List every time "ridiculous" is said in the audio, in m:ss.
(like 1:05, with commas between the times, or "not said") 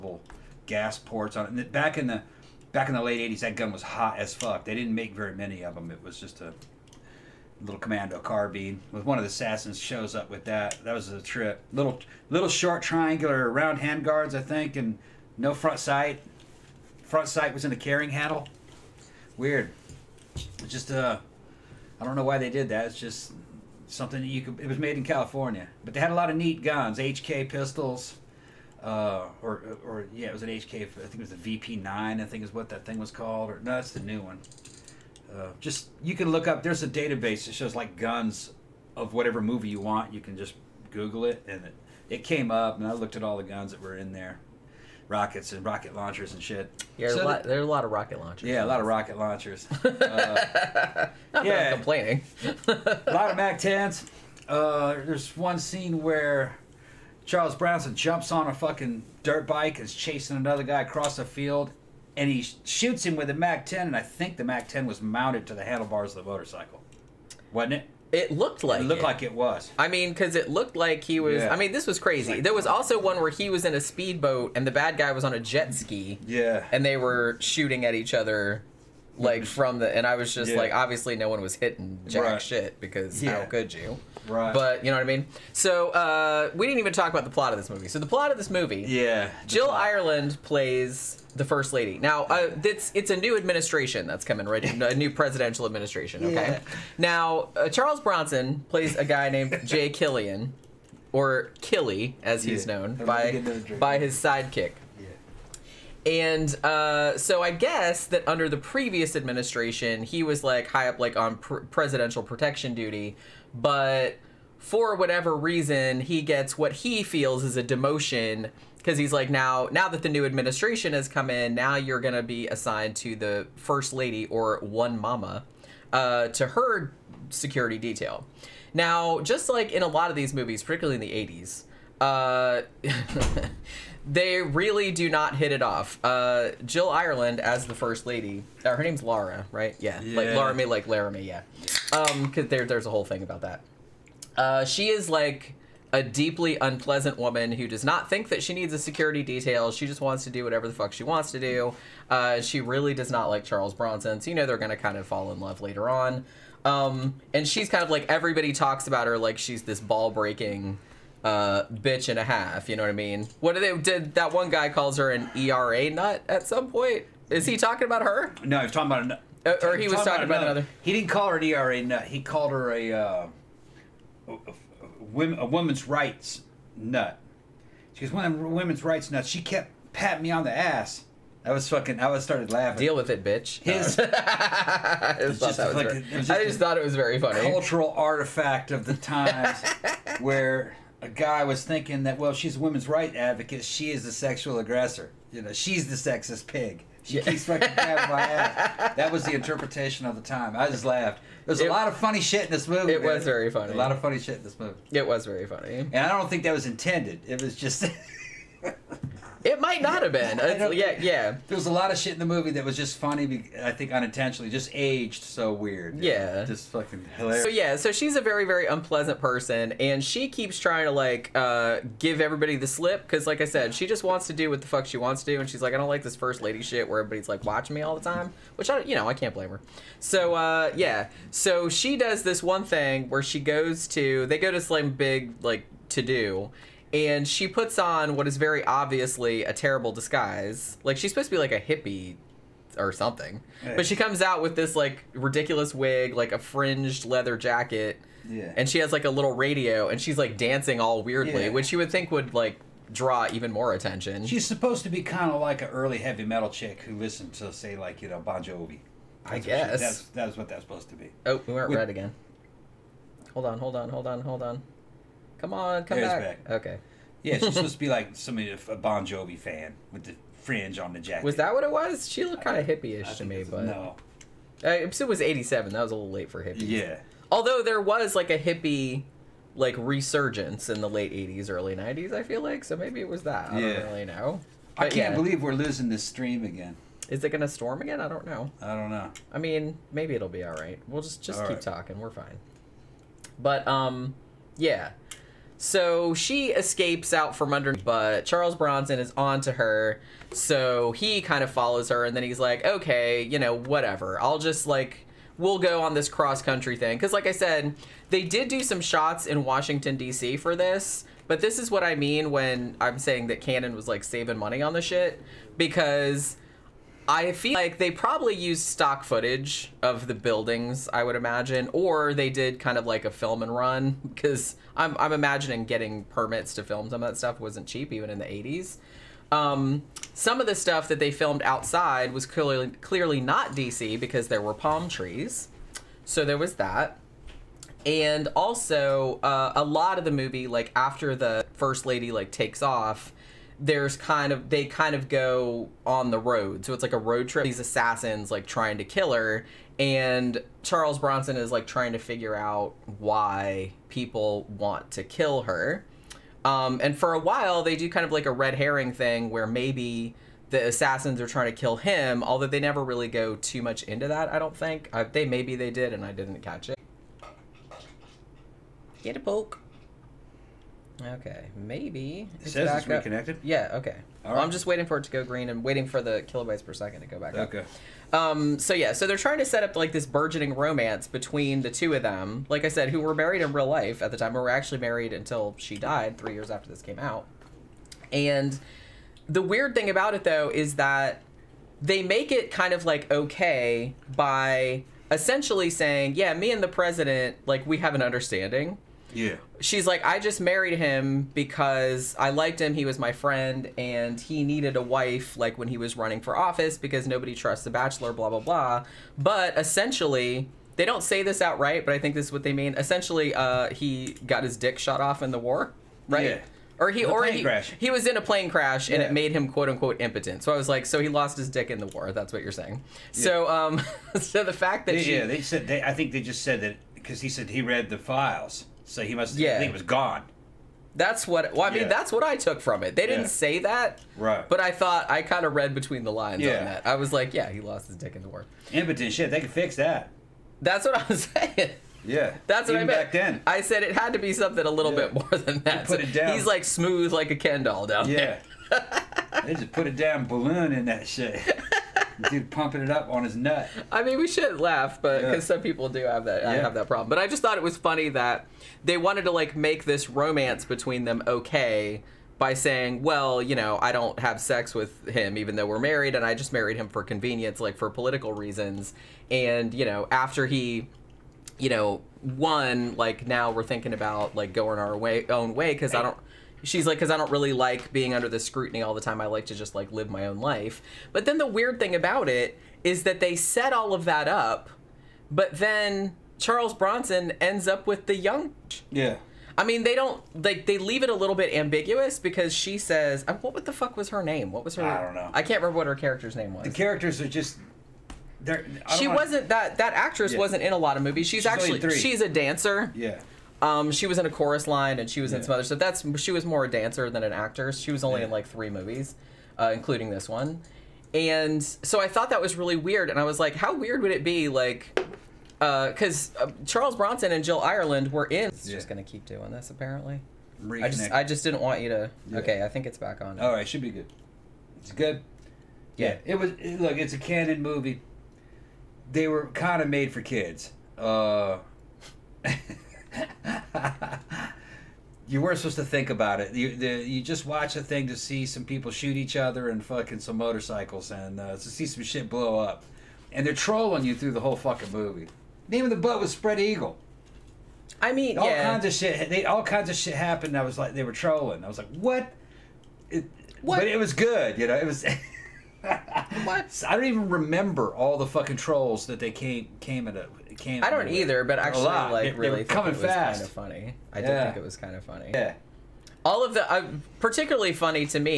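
4:05.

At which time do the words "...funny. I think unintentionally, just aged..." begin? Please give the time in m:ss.
3:32.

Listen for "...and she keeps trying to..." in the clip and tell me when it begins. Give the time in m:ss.
3:39.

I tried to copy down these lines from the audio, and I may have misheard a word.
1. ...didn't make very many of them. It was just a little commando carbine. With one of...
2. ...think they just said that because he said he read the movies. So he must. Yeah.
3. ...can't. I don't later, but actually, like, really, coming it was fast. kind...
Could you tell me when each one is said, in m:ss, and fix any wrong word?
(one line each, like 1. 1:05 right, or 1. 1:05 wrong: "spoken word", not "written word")
1. 0:04 right
2. 7:05 wrong: "files", not "movies"
3. 9:20 wrong: "either", not "later".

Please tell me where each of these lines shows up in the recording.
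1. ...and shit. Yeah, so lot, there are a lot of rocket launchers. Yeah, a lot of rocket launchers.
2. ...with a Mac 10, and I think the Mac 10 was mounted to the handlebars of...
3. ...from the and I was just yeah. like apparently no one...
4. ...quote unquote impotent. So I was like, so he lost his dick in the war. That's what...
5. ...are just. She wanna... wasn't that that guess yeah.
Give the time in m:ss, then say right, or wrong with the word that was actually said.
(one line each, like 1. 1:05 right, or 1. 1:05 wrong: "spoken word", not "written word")
1. 0:46 right
2. 1:03 right
3. 1:19 wrong: "obviously", not "apparently"
4. 6:59 right
5. 8:17 wrong: "actress", not "guess".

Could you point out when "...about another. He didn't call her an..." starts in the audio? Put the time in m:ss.
2:50.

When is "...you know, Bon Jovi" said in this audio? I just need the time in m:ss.
4:18.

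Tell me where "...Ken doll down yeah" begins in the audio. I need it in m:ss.
7:27.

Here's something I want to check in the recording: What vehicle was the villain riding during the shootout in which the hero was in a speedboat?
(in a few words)
jet ski.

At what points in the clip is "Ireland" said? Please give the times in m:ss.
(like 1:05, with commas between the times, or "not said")
1:29, 2:16, 8:37.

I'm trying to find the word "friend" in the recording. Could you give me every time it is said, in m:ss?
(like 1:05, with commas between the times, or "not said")
6:43.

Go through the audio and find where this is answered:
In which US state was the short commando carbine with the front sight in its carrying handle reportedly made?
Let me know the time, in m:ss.
0:25.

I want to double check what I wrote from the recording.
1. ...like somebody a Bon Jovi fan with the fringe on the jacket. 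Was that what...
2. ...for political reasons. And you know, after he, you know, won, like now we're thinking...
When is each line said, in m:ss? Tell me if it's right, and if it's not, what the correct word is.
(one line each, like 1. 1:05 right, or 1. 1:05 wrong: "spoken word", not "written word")
1. 4:27 right
2. 7:47 right.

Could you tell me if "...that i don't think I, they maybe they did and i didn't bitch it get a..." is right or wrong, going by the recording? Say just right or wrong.
wrong.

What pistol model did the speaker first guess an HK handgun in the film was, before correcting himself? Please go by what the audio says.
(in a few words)
VP9.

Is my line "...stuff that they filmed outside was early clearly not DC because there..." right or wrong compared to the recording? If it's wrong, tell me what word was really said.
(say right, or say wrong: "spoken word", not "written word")
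wrong: "clearly", not "early".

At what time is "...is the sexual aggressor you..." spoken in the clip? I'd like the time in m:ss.
3:13.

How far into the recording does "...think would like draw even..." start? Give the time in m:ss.
4:11.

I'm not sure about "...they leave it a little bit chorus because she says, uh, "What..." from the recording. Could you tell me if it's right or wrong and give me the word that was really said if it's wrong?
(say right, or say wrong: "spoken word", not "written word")
wrong: "ambiguous", not "chorus".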